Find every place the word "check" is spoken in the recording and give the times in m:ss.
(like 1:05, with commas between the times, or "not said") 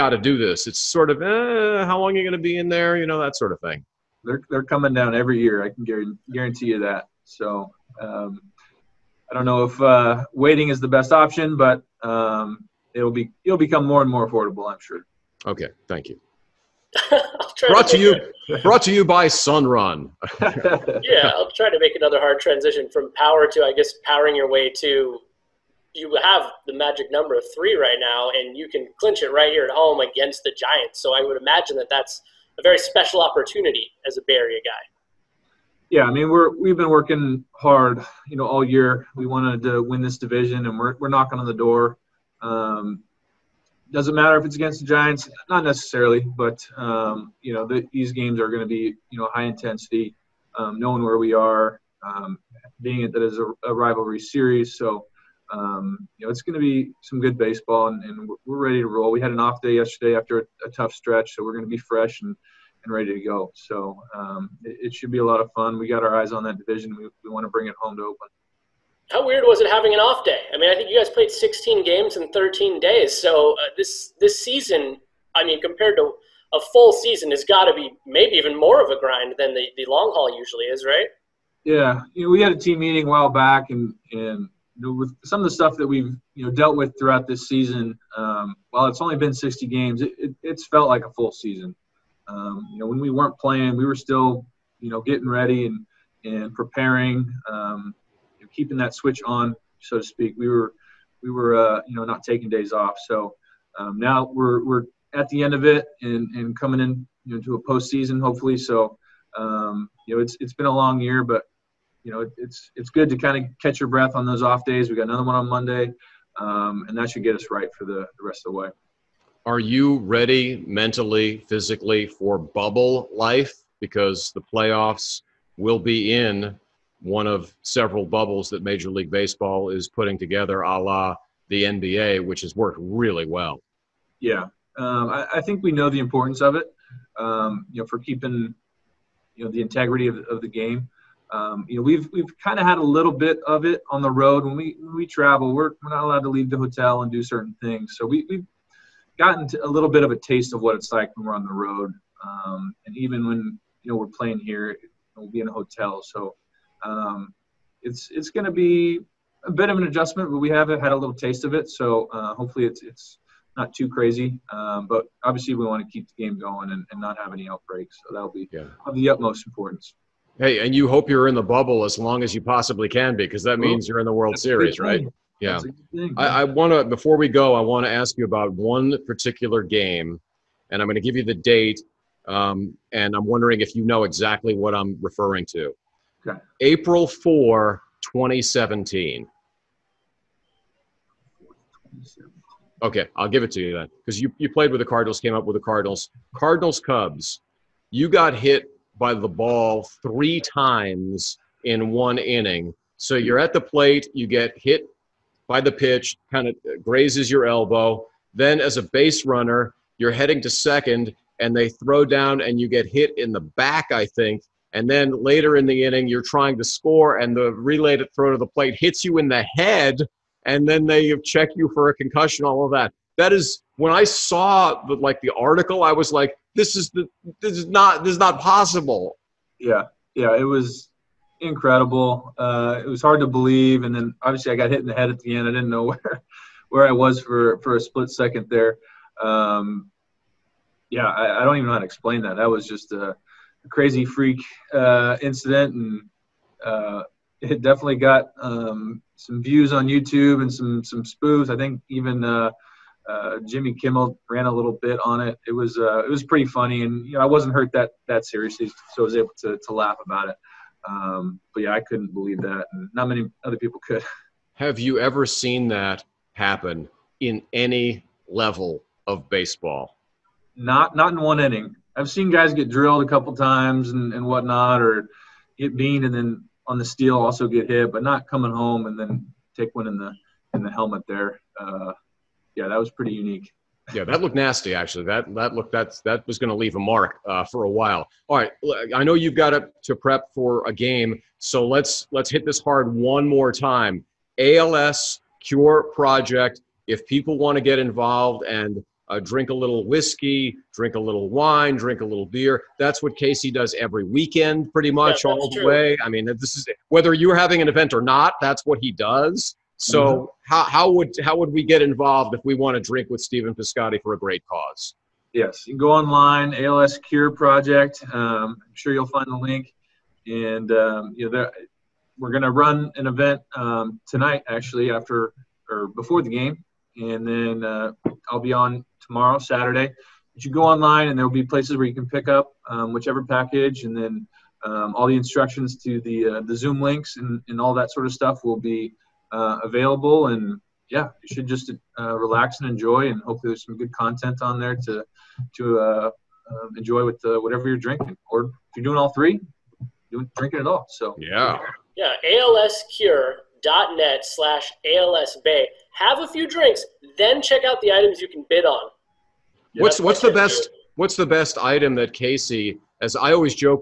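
3:41, 5:57.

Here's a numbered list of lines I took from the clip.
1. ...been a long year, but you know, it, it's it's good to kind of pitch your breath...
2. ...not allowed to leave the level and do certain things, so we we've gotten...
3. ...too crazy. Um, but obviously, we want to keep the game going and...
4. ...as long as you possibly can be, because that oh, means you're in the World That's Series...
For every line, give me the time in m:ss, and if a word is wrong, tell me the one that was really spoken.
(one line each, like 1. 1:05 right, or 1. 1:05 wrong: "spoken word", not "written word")
1. 1:50 wrong: "catch", not "pitch"
2. 2:25 wrong: "hotel", not "level"
3. 2:43 right
4. 2:51 right.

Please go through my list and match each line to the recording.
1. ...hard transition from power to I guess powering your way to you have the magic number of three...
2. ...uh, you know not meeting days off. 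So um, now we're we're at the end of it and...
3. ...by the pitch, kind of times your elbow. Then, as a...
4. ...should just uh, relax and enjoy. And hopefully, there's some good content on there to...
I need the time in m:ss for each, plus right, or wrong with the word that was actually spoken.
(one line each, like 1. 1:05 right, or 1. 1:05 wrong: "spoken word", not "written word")
1. 0:22 right
2. 1:41 wrong: "taking", not "meeting"
3. 3:25 wrong: "grazes", not "times"
4. 5:41 right.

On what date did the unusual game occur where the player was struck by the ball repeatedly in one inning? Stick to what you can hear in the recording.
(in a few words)
April 4, 2017.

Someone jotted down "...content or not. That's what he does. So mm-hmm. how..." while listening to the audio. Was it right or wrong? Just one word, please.
wrong.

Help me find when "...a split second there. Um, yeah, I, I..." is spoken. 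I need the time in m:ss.
3:57.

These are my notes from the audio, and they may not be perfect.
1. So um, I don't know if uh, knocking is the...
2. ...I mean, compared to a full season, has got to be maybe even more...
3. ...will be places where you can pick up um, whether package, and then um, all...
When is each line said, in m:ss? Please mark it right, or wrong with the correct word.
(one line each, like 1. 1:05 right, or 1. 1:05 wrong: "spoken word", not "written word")
1. 0:07 wrong: "waiting", not "knocking"
2. 1:15 right
3. 5:31 wrong: "whichever", not "whether".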